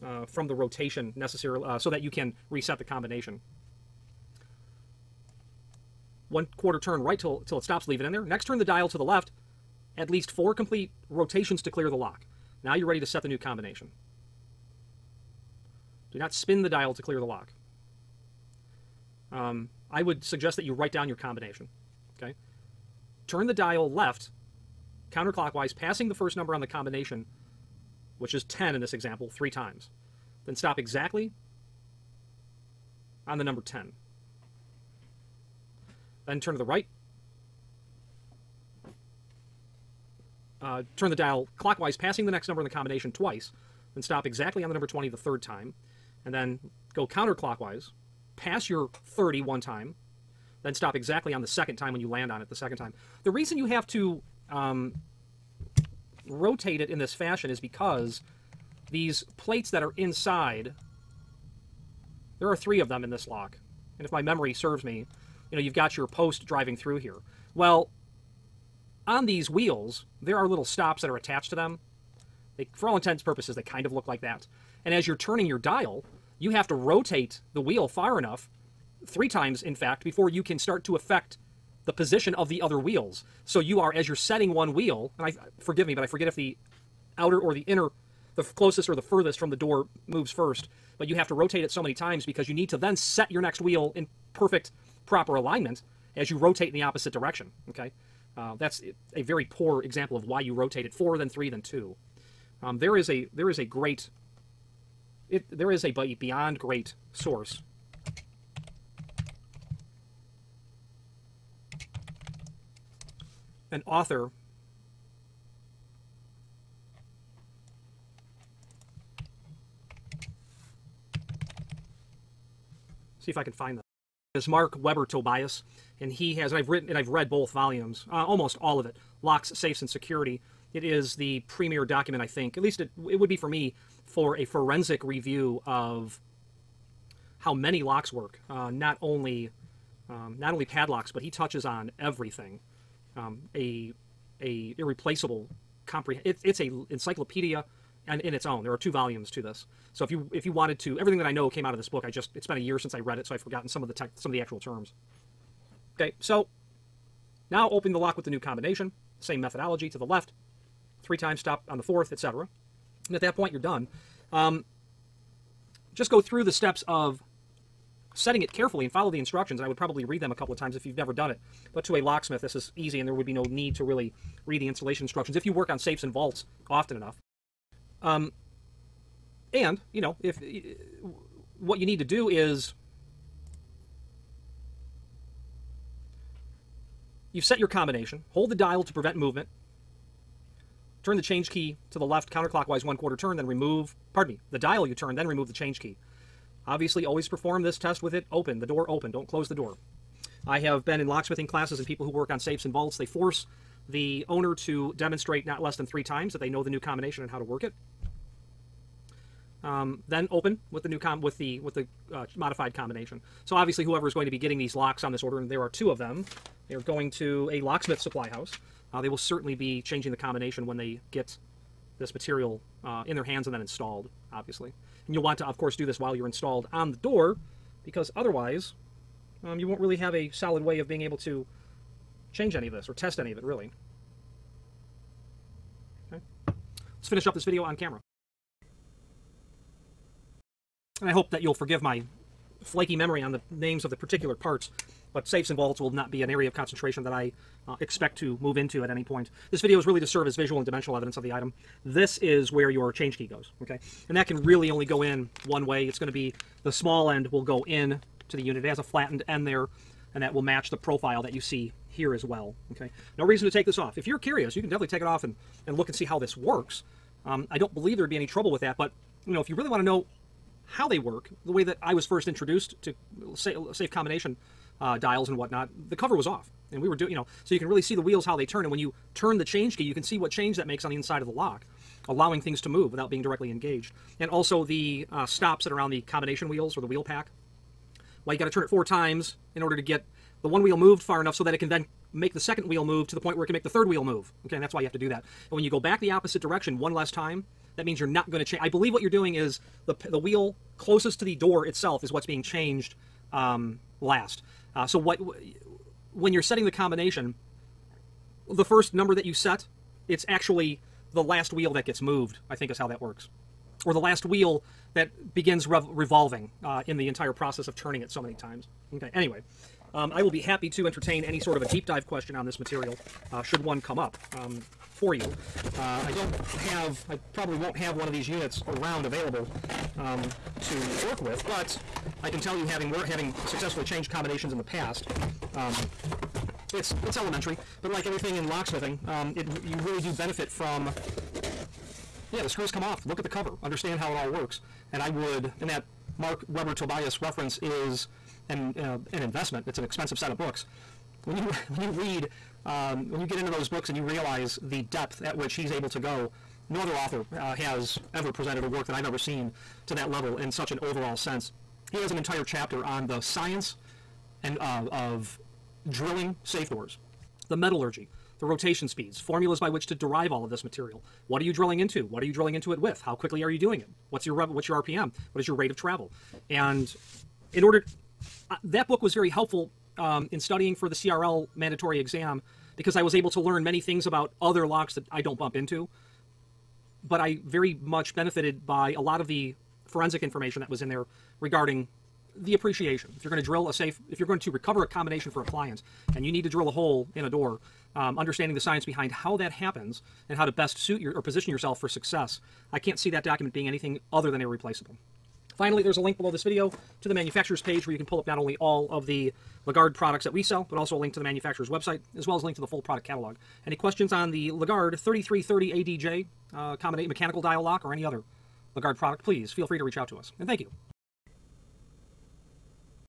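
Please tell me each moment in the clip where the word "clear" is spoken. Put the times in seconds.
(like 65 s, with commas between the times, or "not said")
11 s, 17 s.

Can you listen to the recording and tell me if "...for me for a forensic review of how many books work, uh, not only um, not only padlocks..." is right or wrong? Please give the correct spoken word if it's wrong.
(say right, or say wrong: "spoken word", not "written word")
wrong: "locks", not "books".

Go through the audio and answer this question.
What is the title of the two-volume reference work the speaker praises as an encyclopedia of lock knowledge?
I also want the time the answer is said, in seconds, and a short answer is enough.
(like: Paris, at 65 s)
Locks, Safes, and Security, at 129 s.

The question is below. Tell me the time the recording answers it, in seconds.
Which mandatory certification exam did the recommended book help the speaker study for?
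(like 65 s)
380 s.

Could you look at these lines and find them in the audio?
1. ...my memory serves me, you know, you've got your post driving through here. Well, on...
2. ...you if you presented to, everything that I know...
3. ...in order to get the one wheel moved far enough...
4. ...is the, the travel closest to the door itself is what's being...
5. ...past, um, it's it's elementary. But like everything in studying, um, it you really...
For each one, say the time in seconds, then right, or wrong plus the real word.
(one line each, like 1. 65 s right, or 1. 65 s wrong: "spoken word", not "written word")
1. 64 s right
2. 150 s wrong: "wanted", not "presented"
3. 289 s right
4. 299 s wrong: "wheel", not "travel"
5. 334 s wrong: "locksmithing", not "studying".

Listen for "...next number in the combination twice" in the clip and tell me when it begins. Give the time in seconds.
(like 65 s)
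42 s.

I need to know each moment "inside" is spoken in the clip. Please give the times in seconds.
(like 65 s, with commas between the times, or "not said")
59 s, 280 s.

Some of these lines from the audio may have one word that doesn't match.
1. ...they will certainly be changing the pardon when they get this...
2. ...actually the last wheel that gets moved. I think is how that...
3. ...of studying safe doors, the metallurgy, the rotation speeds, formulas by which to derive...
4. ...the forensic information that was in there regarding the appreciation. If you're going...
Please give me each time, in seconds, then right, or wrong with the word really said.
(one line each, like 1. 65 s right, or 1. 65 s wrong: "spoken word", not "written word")
1. 219 s wrong: "combination", not "pardon"
2. 310 s right
3. 364 s wrong: "drilling", not "studying"
4. 389 s right.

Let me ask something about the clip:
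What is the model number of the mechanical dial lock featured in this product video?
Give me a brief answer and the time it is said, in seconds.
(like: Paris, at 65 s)
3330 ADJ, at 414 s.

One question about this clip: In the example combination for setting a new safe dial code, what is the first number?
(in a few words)
10.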